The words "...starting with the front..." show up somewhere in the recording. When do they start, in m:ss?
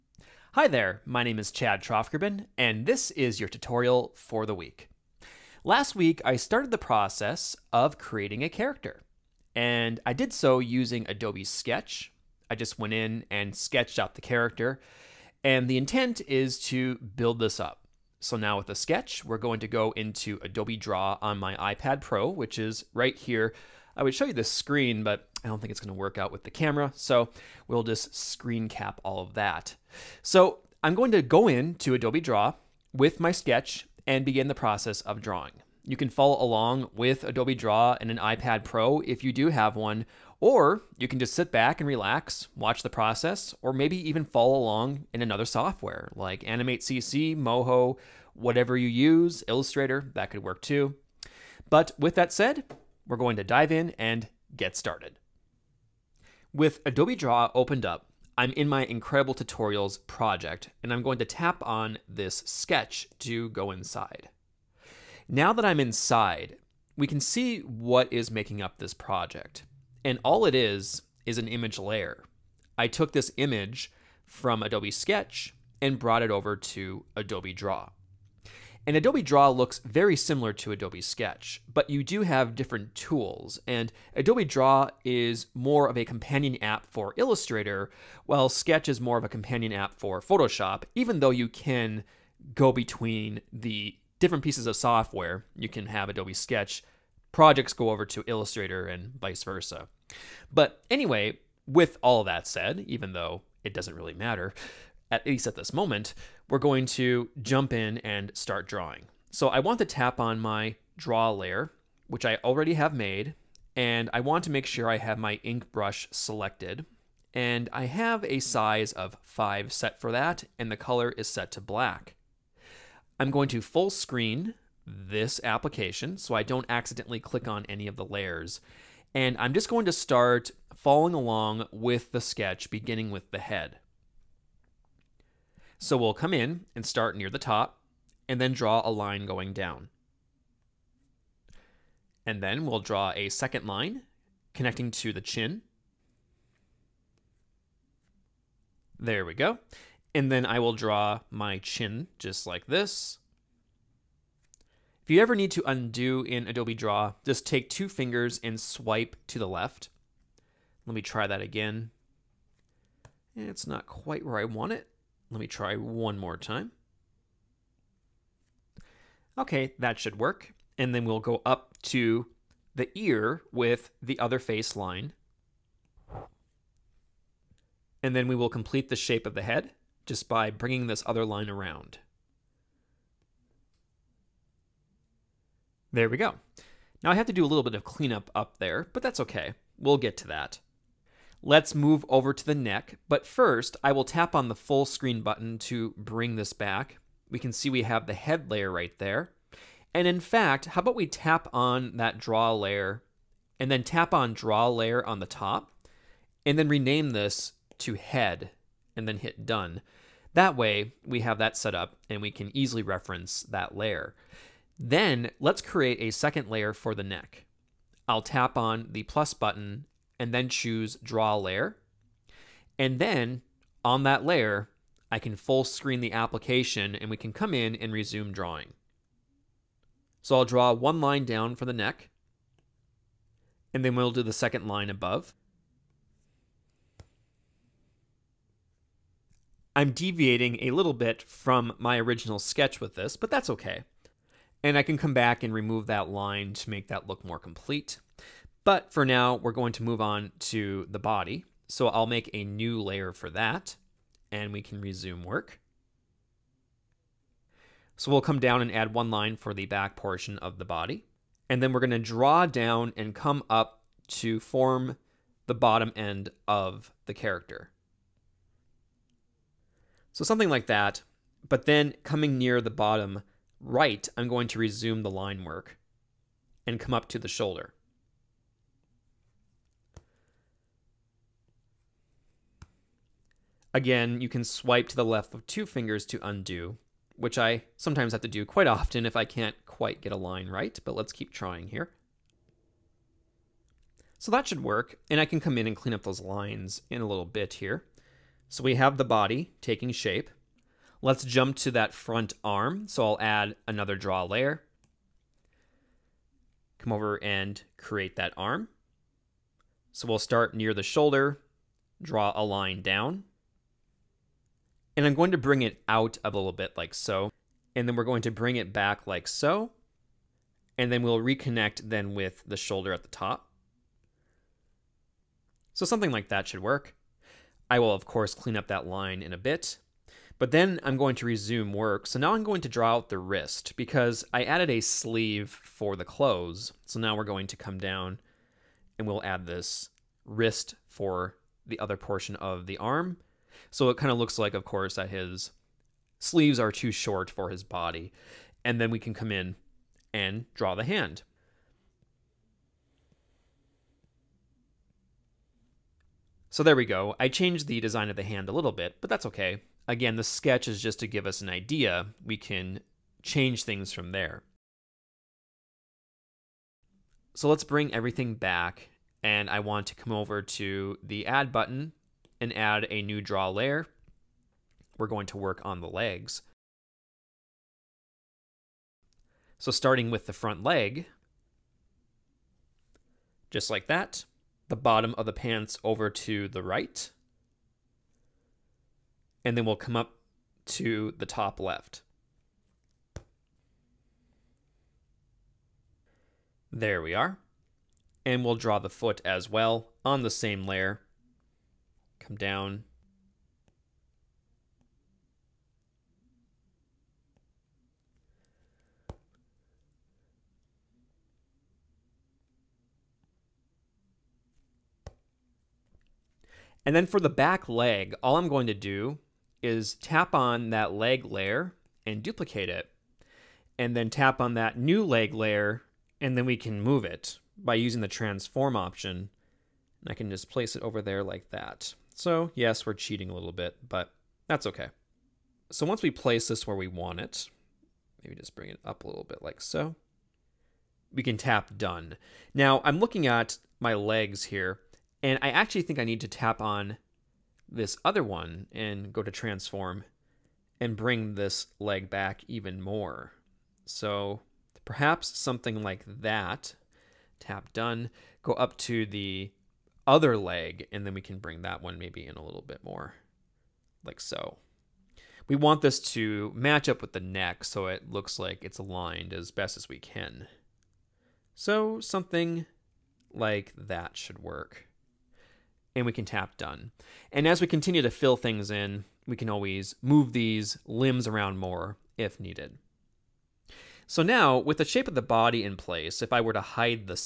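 6:19.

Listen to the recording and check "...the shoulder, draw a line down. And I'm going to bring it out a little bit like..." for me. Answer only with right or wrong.
right.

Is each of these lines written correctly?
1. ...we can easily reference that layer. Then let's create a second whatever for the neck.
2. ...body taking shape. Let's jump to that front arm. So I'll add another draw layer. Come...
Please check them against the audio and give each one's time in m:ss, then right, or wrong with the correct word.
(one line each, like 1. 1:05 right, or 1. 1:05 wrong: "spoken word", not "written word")
1. 3:32 wrong: "layer", not "whatever"
2. 4:59 right.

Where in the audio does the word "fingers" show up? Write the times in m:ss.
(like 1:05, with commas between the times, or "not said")
2:37, 4:45.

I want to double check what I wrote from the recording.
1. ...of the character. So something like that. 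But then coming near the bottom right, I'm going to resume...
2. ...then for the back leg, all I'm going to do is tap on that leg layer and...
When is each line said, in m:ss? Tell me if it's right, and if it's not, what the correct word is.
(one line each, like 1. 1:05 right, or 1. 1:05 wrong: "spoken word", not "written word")
1. 4:26 right
2. 6:56 right.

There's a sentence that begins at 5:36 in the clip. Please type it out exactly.
So now we're going to come down and we'll add this wrist for the other portion of the arm.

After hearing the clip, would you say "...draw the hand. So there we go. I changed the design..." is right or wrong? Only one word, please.
right.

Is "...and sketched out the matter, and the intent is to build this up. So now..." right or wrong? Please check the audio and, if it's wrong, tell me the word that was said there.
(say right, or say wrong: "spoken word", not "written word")
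wrong: "character", not "matter".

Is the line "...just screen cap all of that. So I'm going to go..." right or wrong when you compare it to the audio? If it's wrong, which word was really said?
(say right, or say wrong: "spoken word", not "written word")
right.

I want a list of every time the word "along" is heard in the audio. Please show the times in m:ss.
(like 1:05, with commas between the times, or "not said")
0:36, 0:44, 2:11.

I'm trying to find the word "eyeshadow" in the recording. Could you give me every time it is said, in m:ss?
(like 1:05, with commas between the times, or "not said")
not said.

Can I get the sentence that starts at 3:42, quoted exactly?
And then on that layer, I can full screen the application and we can come in and resume drawing.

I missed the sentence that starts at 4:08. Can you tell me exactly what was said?
But for now, we're going to move on to the body.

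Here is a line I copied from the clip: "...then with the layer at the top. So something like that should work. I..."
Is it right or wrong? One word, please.
wrong.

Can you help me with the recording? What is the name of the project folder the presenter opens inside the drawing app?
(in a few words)
Incredible Tutorials.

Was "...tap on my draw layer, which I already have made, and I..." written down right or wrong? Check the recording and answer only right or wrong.
right.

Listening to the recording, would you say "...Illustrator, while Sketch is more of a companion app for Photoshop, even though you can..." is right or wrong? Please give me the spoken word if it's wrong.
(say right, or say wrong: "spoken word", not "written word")
right.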